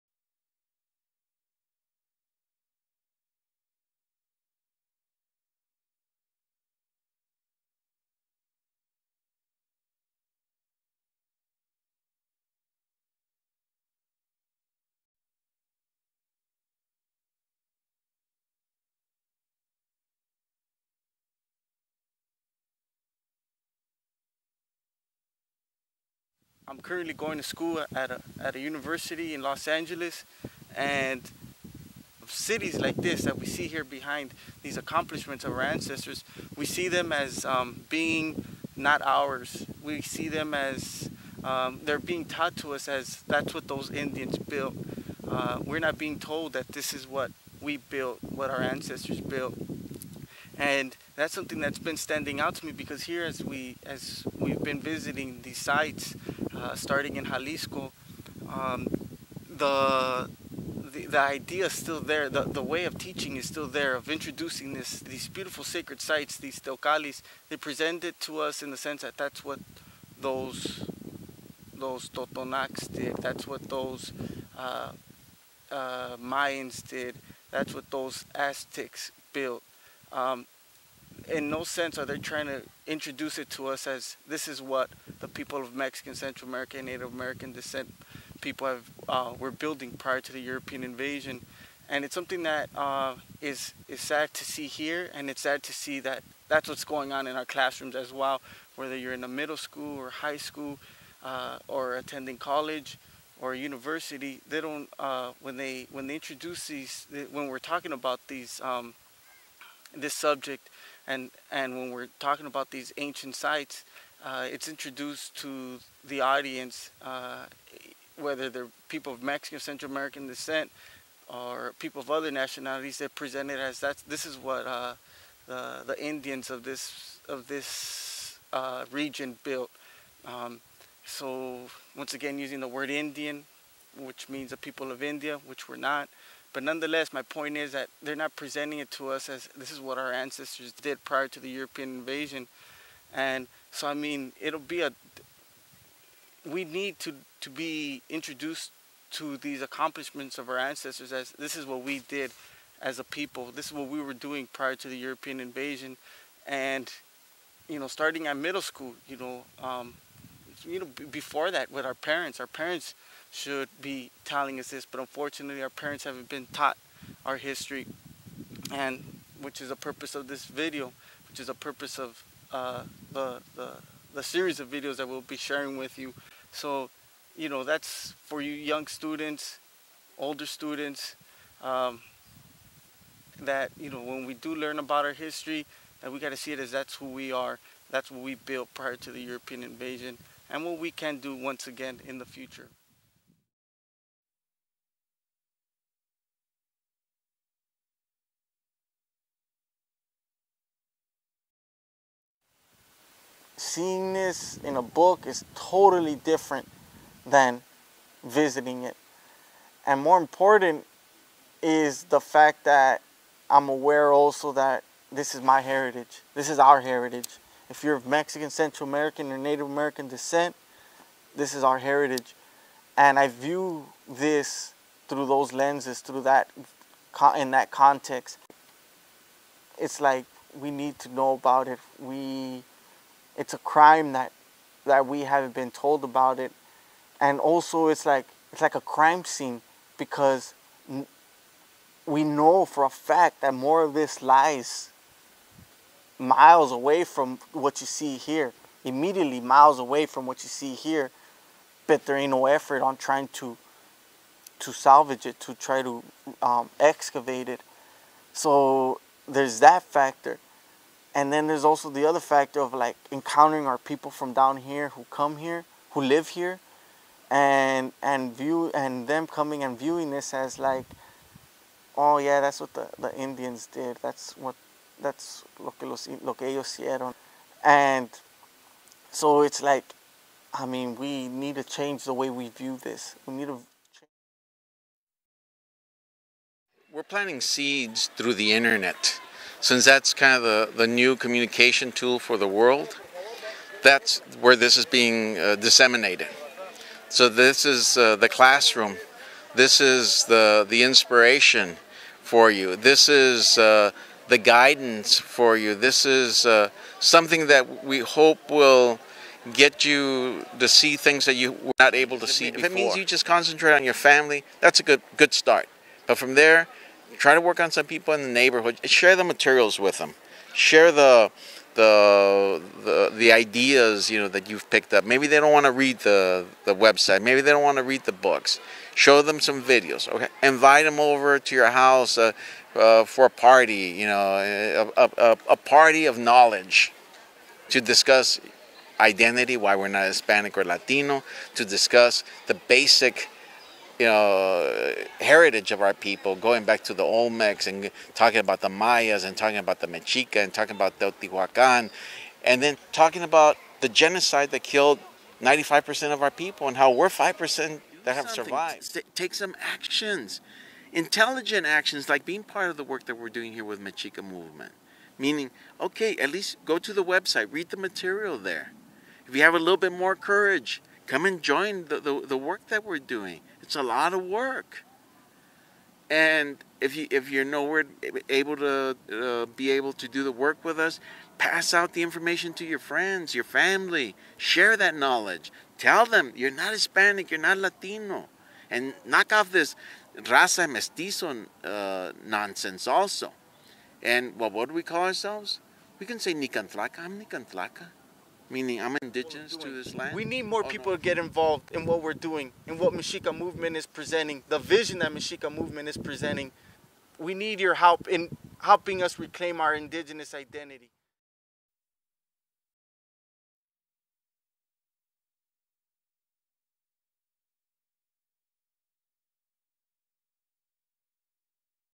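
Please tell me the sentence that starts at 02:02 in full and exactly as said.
They're presented as that's this is what uh, the the Indians of this of this uh, region built.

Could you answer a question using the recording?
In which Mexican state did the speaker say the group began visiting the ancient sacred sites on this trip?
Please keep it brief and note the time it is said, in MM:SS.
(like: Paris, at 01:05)
Jalisco, at 00:57.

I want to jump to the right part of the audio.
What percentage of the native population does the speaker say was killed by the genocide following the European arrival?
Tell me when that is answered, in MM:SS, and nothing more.
05:55.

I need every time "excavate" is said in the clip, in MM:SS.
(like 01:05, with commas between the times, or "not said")
04:16.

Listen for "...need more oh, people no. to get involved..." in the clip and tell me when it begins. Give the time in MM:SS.
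06:40.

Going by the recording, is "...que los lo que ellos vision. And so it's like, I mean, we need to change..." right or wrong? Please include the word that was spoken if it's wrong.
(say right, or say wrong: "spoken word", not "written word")
wrong: "hicieron", not "vision".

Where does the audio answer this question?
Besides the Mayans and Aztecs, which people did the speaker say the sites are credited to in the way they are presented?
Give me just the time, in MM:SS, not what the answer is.
01:12.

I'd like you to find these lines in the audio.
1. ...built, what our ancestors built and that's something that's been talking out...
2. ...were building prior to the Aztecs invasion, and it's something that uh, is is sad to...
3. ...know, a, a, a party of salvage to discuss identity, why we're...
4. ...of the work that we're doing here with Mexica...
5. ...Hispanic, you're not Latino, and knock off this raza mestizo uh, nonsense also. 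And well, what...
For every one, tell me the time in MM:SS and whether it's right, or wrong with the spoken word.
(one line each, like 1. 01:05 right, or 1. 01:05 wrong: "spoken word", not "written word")
1. 00:47 wrong: "standing", not "talking"
2. 01:29 wrong: "European", not "Aztecs"
3. 05:34 wrong: "knowledge", not "salvage"
4. 06:02 right
5. 06:26 right.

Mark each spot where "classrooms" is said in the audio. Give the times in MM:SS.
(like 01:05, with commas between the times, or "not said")
01:37, 04:58.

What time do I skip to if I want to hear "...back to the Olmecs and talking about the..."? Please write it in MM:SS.
05:46.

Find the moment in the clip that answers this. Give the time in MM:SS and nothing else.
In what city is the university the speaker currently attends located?
00:29.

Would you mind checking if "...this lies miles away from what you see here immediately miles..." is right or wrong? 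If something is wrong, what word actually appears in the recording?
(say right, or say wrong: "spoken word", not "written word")
right.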